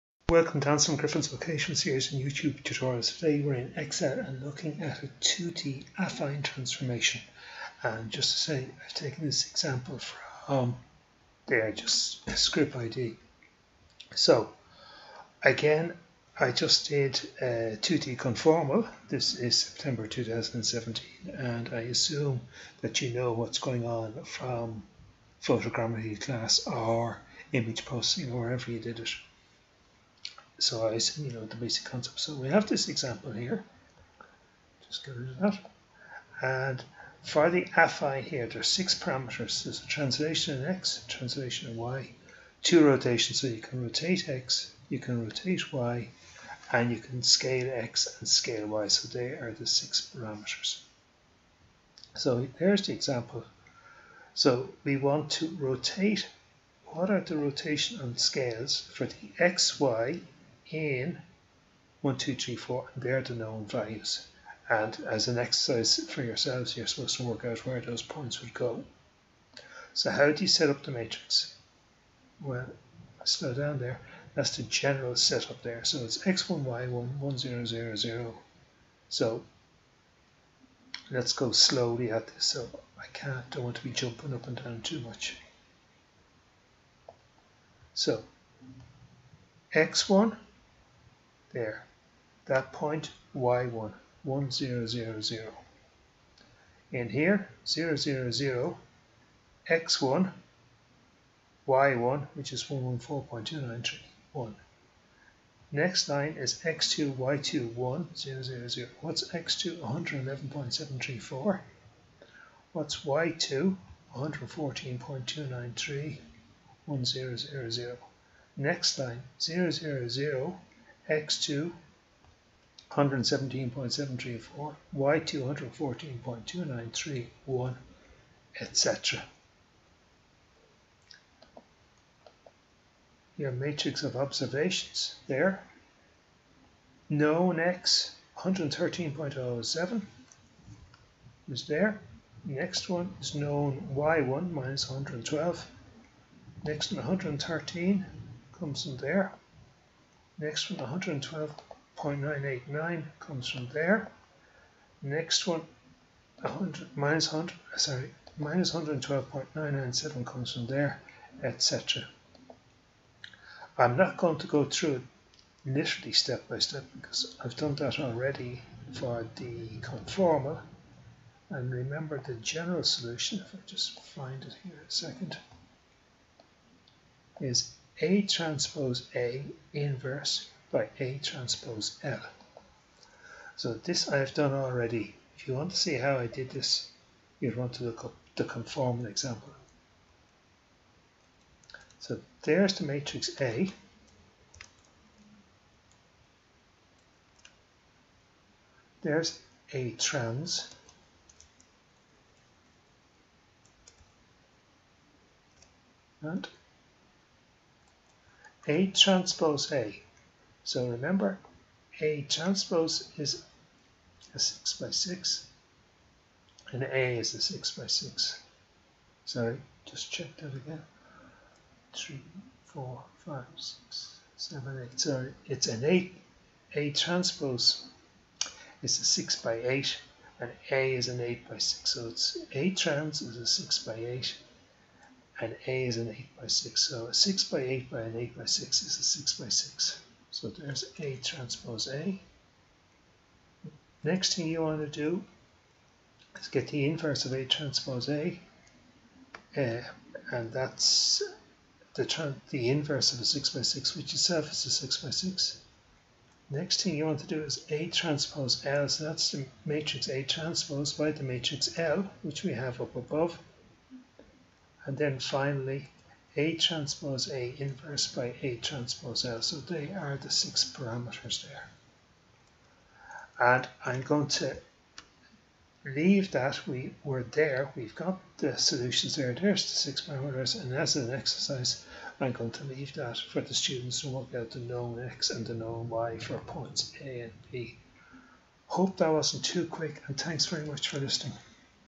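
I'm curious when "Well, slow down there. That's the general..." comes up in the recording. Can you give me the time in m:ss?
1:12.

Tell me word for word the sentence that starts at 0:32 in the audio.
So we have this example here.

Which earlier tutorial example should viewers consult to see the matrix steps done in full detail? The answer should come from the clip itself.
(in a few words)
the conformal example.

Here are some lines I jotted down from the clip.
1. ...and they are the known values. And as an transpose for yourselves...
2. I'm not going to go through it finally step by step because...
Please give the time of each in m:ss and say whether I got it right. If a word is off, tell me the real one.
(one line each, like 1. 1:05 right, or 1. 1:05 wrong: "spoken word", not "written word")
1. 1:02 wrong: "exercise", not "transpose"
2. 2:43 wrong: "literally", not "finally".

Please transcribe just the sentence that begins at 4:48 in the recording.
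Hope that wasn't too quick and thanks very much for listening.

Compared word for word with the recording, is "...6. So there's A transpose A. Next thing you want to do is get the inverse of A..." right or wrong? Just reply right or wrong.
right.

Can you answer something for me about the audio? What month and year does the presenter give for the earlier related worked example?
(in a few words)
September 2017.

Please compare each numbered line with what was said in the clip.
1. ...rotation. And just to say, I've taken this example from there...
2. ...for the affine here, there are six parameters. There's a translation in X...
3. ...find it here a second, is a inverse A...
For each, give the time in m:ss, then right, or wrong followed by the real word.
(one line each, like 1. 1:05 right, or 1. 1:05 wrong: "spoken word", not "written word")
1. 0:06 wrong: "transformation", not "rotation"
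2. 0:37 right
3. 2:54 wrong: "transpose", not "inverse".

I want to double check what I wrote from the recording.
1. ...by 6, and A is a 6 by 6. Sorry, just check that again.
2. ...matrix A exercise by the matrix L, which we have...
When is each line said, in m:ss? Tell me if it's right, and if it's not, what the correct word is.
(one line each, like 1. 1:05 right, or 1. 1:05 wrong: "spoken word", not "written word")
1. 3:34 right
2. 4:19 wrong: "transpose", not "exercise".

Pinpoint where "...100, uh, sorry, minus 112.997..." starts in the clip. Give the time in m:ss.
2:37.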